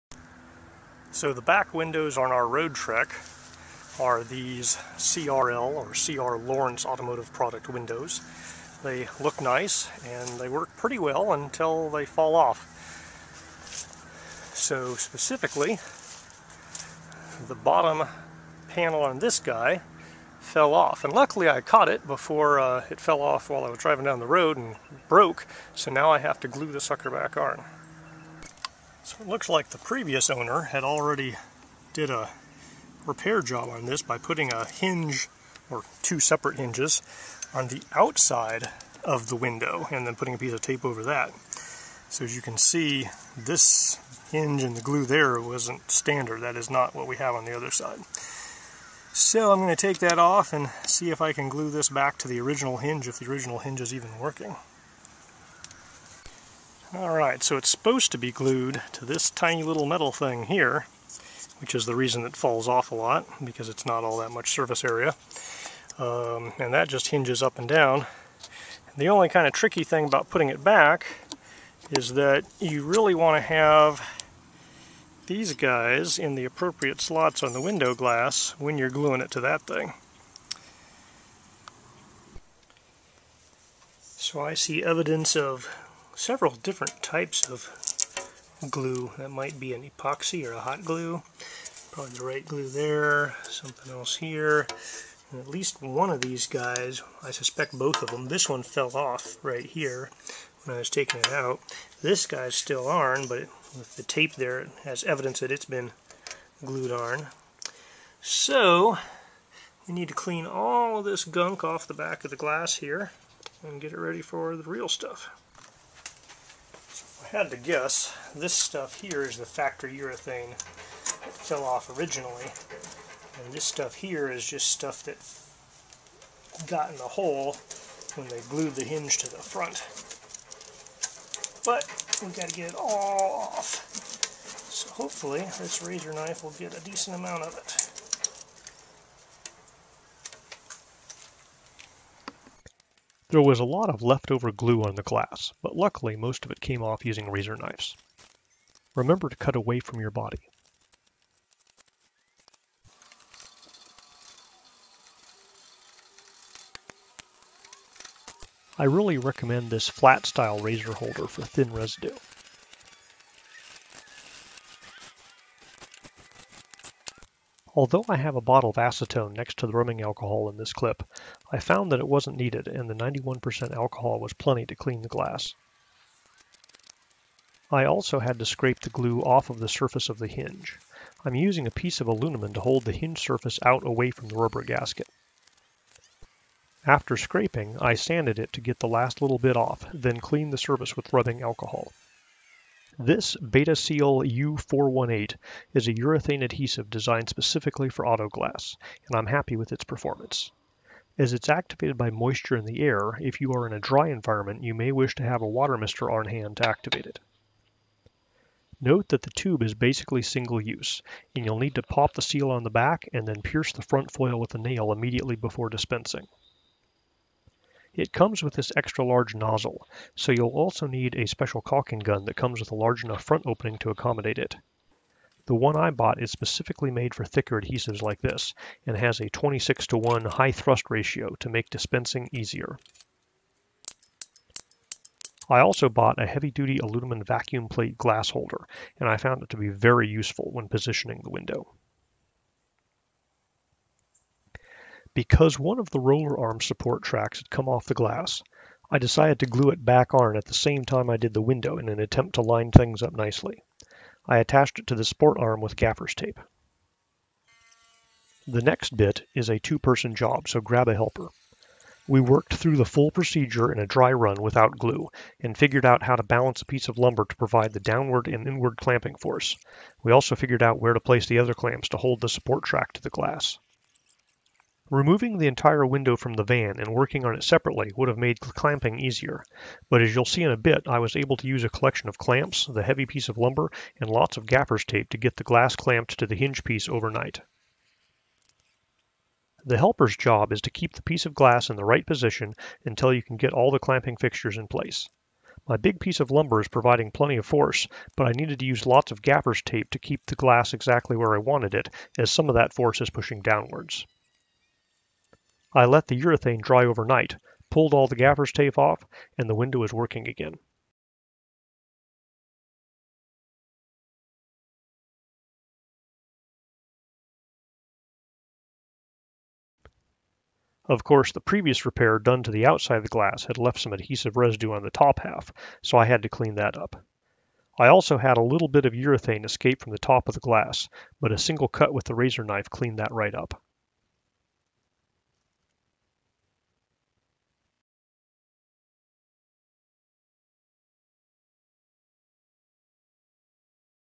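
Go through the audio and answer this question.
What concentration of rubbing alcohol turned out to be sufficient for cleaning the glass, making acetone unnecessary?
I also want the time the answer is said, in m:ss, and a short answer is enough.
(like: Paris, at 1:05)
91%, at 2:52.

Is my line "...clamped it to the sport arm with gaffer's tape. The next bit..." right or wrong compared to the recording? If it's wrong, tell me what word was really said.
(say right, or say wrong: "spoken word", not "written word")
wrong: "attached", not "clamped".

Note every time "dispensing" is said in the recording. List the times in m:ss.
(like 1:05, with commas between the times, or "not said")
3:35, 3:51.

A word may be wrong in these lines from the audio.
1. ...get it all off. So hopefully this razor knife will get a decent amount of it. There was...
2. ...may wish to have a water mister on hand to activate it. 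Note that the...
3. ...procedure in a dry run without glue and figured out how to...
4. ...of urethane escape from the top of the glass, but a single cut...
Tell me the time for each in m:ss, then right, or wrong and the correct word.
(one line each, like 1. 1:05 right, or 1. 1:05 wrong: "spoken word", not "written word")
1. 2:12 right
2. 3:24 right
3. 4:23 right
4. 5:28 right.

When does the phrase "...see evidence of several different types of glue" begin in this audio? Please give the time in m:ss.
1:24.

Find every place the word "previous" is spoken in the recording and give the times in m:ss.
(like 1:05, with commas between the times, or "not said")
0:29, 5:21.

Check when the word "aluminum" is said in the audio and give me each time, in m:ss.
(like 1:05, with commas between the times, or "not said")
3:02, 3:56.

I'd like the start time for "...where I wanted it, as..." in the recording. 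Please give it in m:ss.
5:01.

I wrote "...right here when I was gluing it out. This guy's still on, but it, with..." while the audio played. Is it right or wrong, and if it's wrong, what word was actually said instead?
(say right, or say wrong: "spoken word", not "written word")
wrong: "taking", not "gluing".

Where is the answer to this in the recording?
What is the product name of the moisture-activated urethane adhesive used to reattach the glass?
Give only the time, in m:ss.
3:13.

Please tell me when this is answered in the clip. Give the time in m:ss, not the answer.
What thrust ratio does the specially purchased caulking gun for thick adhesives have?
3:49.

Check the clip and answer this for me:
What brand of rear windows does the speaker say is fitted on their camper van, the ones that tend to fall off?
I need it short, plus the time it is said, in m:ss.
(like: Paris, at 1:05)
CR Lawrence, at 0:05.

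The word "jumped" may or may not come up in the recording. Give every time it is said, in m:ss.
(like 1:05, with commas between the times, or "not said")
not said.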